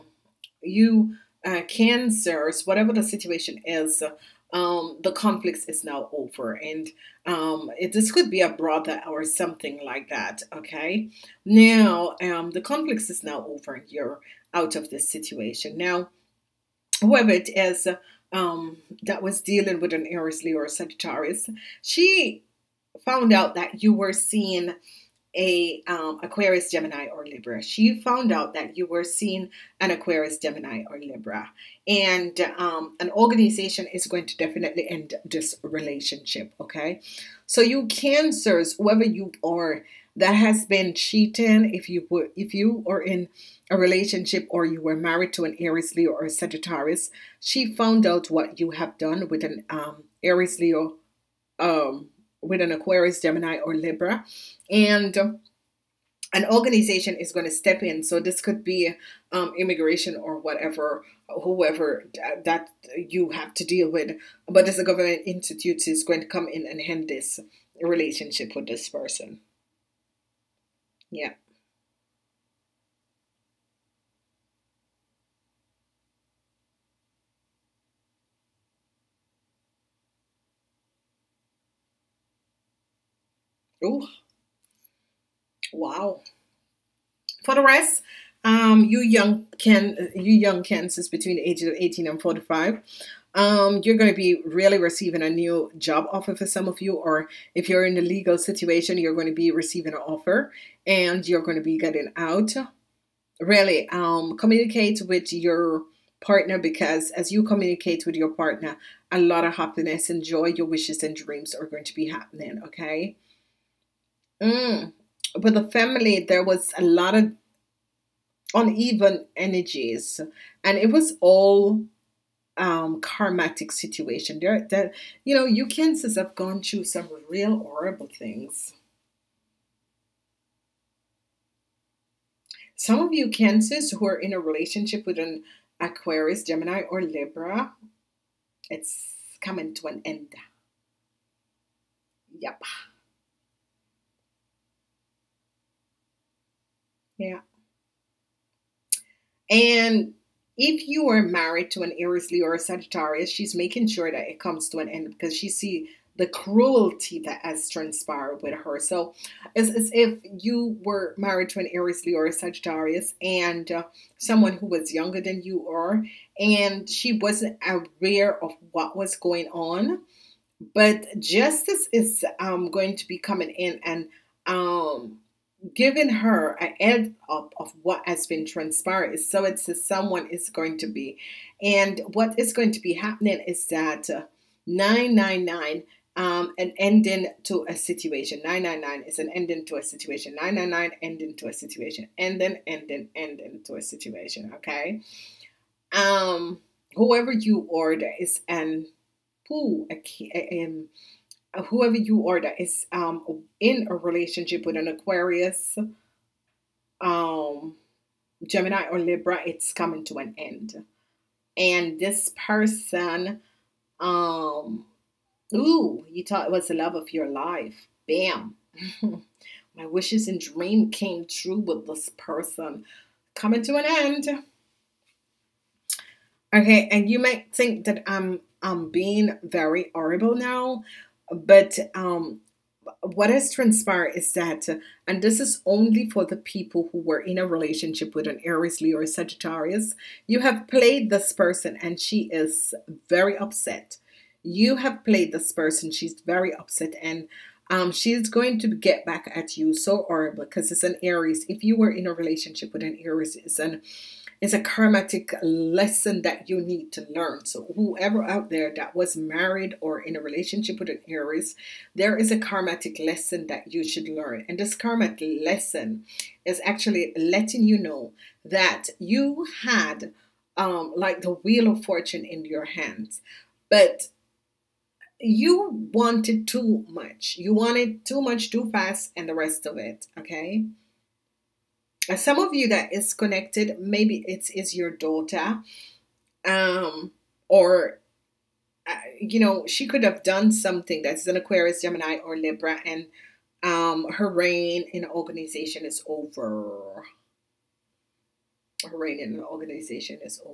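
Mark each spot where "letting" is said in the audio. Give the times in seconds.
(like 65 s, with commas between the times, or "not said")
267 s.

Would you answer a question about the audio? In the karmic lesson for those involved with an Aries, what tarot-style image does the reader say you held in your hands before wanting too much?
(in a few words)
The wheel of fortune.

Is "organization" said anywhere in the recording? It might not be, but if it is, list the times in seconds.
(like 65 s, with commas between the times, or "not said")
33 s, 56 s, 295 s, 299 s.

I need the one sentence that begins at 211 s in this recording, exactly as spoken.
And this person, um, ooh, you thought it was the love of your life.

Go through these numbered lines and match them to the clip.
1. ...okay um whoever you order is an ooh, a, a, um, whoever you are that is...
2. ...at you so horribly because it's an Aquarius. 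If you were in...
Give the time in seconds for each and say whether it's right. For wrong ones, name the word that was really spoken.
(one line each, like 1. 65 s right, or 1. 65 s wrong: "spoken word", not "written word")
1. 194 s right
2. 249 s wrong: "Aries", not "Aquarius".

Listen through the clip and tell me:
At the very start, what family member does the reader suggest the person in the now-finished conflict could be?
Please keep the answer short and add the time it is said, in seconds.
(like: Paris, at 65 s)
A brother, at 8 s.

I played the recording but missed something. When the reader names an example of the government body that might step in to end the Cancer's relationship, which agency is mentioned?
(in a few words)
Immigration.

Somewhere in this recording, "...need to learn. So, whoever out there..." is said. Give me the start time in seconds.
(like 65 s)
256 s.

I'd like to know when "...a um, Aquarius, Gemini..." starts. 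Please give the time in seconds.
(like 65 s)
25 s.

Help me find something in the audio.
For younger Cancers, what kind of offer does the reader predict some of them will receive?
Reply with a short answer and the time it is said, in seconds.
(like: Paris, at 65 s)
A new job offer, at 95 s.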